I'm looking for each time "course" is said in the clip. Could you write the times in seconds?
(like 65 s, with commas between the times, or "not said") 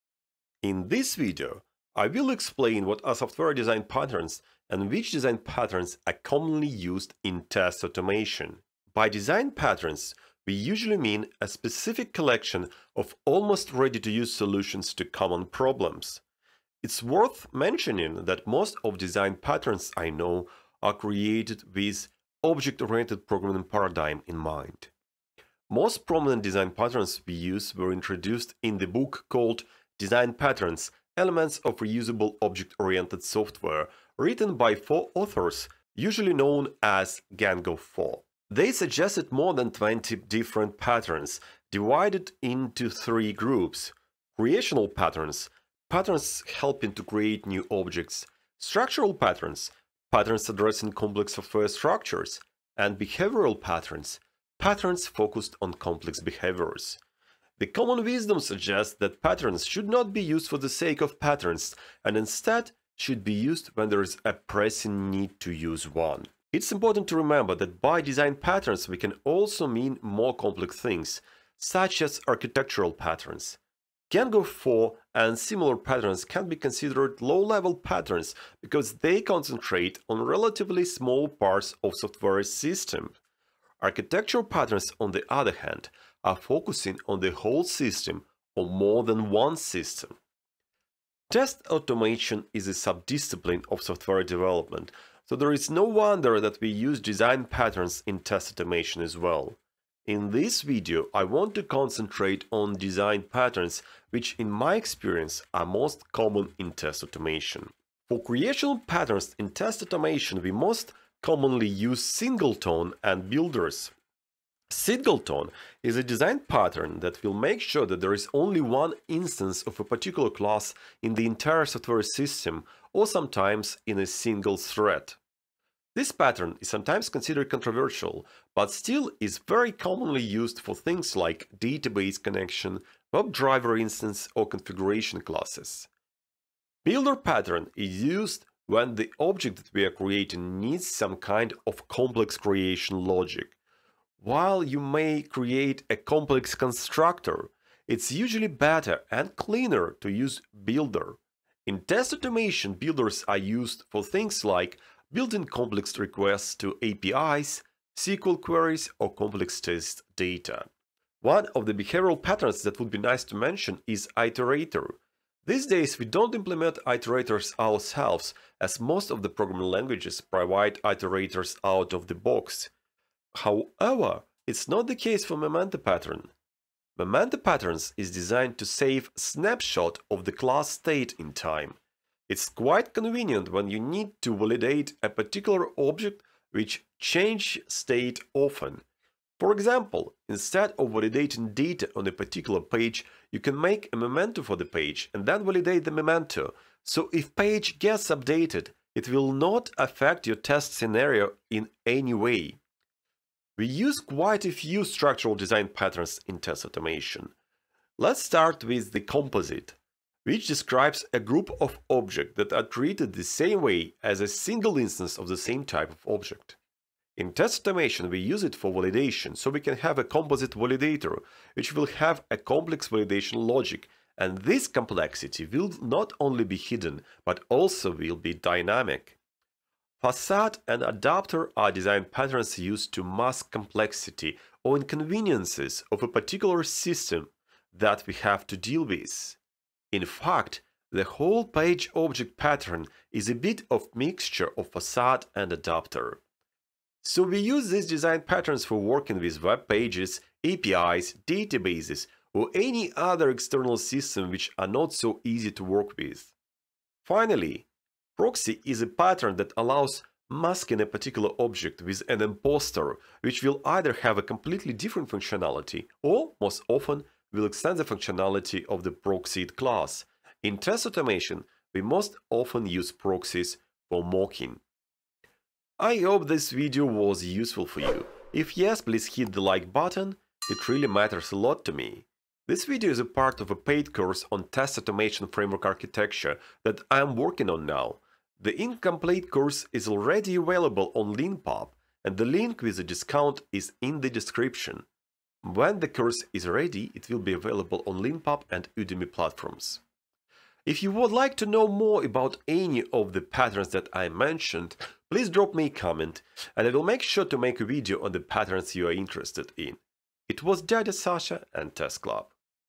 283 s, 289 s, 295 s.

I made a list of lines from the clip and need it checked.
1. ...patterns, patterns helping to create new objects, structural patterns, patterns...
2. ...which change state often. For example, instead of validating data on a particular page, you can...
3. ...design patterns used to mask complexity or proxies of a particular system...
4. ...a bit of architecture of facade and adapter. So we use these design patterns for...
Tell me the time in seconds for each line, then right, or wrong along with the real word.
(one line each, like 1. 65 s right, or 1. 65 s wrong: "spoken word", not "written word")
1. 44 s right
2. 186 s right
3. 231 s wrong: "inconveniences", not "proxies"
4. 243 s wrong: "mixture", not "architecture".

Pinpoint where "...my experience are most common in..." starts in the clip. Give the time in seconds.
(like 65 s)
104 s.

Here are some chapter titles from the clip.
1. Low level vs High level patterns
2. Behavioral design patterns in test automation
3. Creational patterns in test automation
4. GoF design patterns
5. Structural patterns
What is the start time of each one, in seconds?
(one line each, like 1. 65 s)
1. 70 s
2. 160 s
3. 113 s
4. 30 s
5. 203 s.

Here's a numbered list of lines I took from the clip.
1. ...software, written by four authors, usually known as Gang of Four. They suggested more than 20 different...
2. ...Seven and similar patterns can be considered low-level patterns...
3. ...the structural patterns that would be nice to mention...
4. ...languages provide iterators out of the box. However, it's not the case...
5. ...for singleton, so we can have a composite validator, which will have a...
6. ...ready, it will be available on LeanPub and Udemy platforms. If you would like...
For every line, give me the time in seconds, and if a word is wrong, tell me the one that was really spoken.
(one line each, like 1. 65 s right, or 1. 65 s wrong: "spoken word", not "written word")
1. 33 s right
2. 74 s wrong: "Four", not "Seven"
3. 161 s wrong: "behavioral", not "structural"
4. 169 s right
5. 218 s wrong: "validation", not "singleton"
6. 296 s right.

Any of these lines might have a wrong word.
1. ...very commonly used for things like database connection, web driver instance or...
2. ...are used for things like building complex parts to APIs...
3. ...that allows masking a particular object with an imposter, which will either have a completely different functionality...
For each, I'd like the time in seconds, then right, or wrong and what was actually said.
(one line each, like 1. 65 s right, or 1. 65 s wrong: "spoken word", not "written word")
1. 129 s right
2. 153 s wrong: "requests", not "parts"
3. 259 s right.